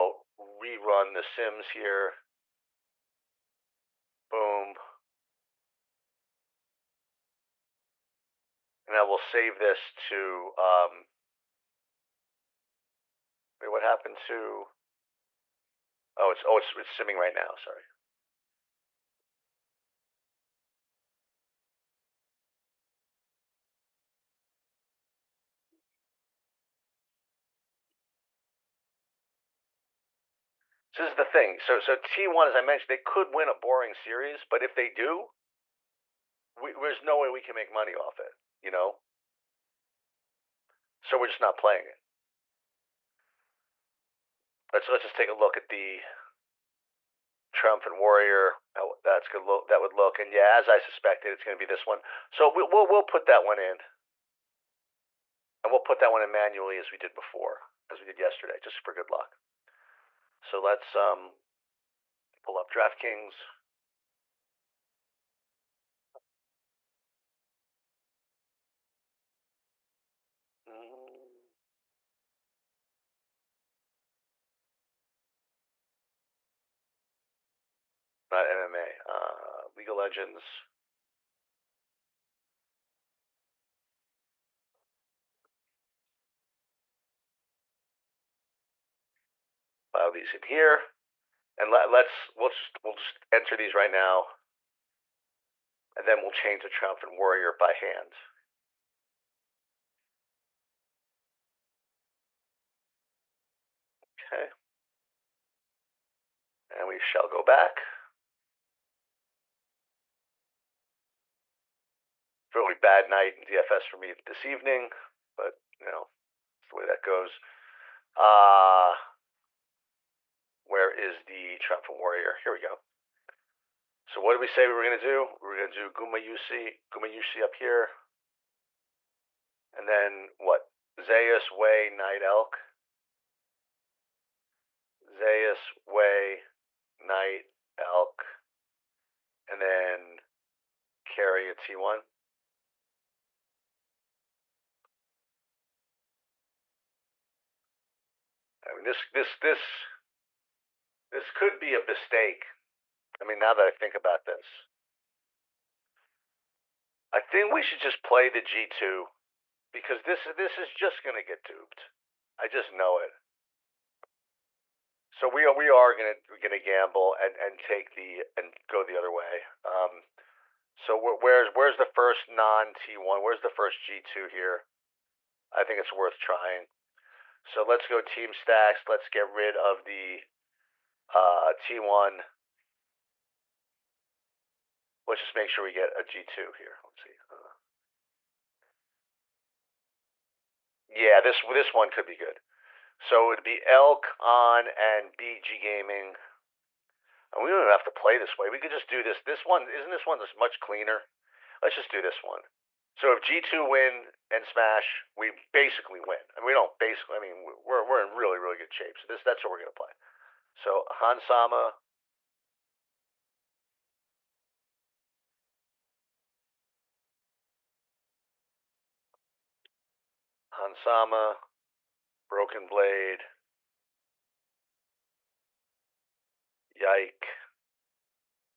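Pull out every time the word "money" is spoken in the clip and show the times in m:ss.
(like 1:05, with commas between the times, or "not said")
0:37.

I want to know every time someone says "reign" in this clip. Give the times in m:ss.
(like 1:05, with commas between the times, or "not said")
not said.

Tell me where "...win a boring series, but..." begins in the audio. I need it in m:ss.
0:33.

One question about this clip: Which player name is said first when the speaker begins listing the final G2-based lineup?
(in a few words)
Hans Sama.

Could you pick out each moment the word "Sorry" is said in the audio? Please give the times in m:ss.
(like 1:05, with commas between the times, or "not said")
0:17.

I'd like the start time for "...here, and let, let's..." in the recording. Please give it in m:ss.
1:30.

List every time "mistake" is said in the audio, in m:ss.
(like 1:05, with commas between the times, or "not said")
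2:31.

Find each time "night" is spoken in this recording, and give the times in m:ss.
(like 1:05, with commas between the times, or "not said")
1:53, 2:11, 2:16.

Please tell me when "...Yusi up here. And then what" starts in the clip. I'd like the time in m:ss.
2:07.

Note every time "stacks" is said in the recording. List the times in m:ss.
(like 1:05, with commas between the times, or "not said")
2:58.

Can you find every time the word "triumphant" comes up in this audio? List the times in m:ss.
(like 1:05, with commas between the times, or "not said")
0:47, 1:36, 2:01.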